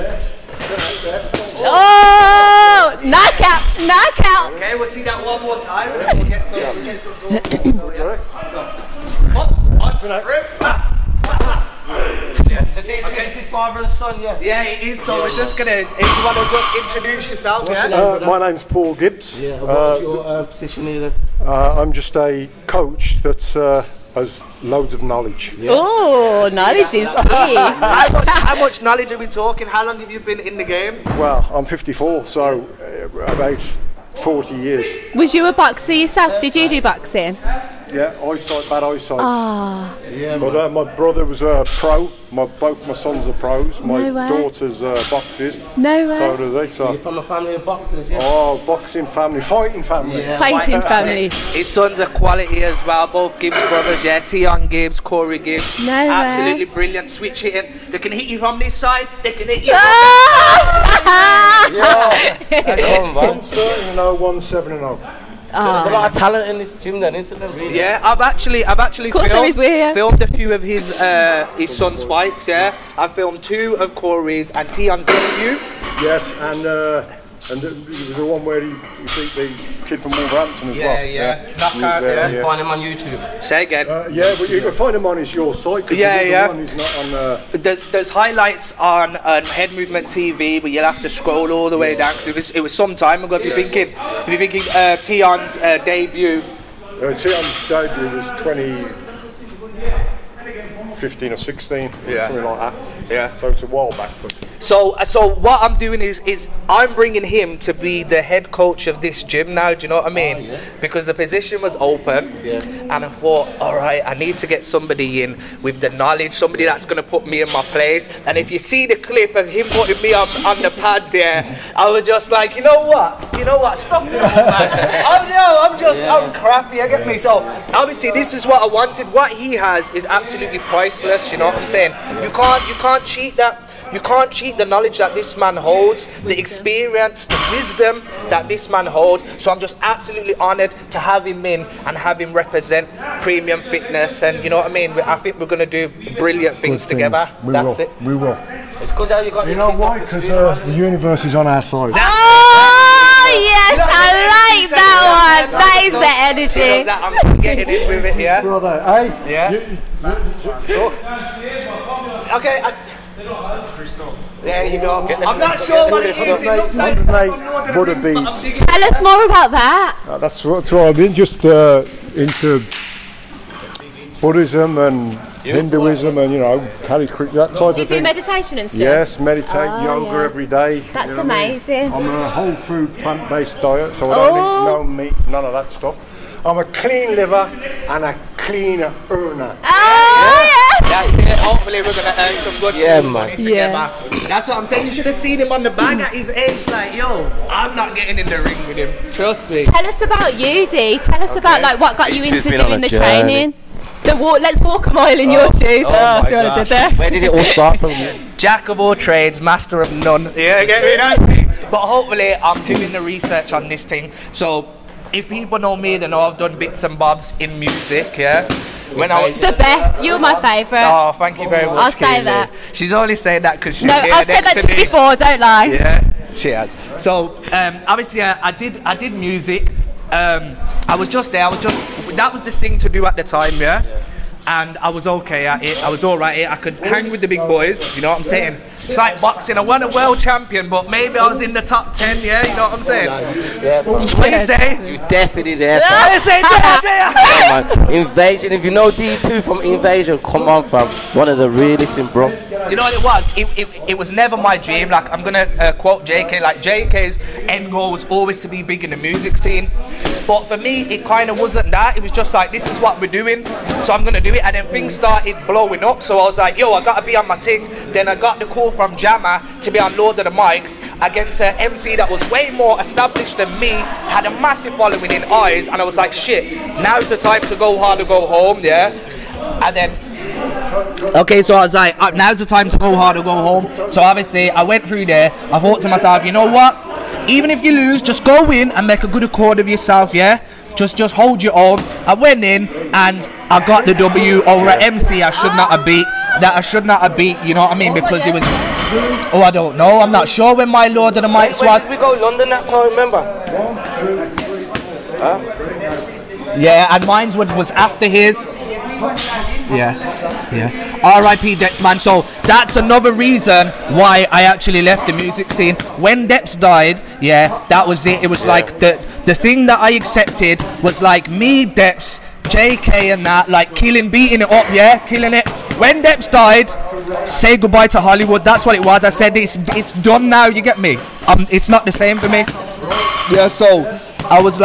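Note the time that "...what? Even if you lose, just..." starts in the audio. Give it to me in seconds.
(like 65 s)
286 s.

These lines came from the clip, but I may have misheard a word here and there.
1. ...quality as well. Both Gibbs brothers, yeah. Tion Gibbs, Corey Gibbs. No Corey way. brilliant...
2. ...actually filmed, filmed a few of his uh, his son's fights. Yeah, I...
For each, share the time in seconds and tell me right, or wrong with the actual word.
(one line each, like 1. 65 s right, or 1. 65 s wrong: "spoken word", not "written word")
1. 52 s wrong: "Absolutely", not "Corey"
2. 68 s right.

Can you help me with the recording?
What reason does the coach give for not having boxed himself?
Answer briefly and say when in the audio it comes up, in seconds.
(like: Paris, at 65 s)
Bad eyesight, at 38 s.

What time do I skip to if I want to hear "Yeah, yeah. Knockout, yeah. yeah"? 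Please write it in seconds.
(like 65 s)
81 s.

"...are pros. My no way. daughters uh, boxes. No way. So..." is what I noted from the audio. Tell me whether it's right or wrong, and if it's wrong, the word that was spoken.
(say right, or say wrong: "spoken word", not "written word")
right.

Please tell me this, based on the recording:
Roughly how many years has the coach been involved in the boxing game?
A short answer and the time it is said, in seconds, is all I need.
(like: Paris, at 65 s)
40 years, at 33 s.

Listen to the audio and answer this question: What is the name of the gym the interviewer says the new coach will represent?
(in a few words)
Premium Fitness.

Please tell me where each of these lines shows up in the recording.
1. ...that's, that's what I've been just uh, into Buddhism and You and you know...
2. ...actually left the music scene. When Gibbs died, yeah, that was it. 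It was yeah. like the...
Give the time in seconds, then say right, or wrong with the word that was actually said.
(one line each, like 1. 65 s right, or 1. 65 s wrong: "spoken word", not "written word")
1. 170 s wrong: "Hinduism", not "You"
2. 314 s wrong: "Depz", not "Gibbs".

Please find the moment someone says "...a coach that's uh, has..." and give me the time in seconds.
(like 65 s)
22 s.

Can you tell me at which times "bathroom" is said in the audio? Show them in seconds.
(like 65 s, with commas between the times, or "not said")
not said.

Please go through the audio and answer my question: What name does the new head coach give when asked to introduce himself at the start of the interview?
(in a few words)
Paul Gibbs.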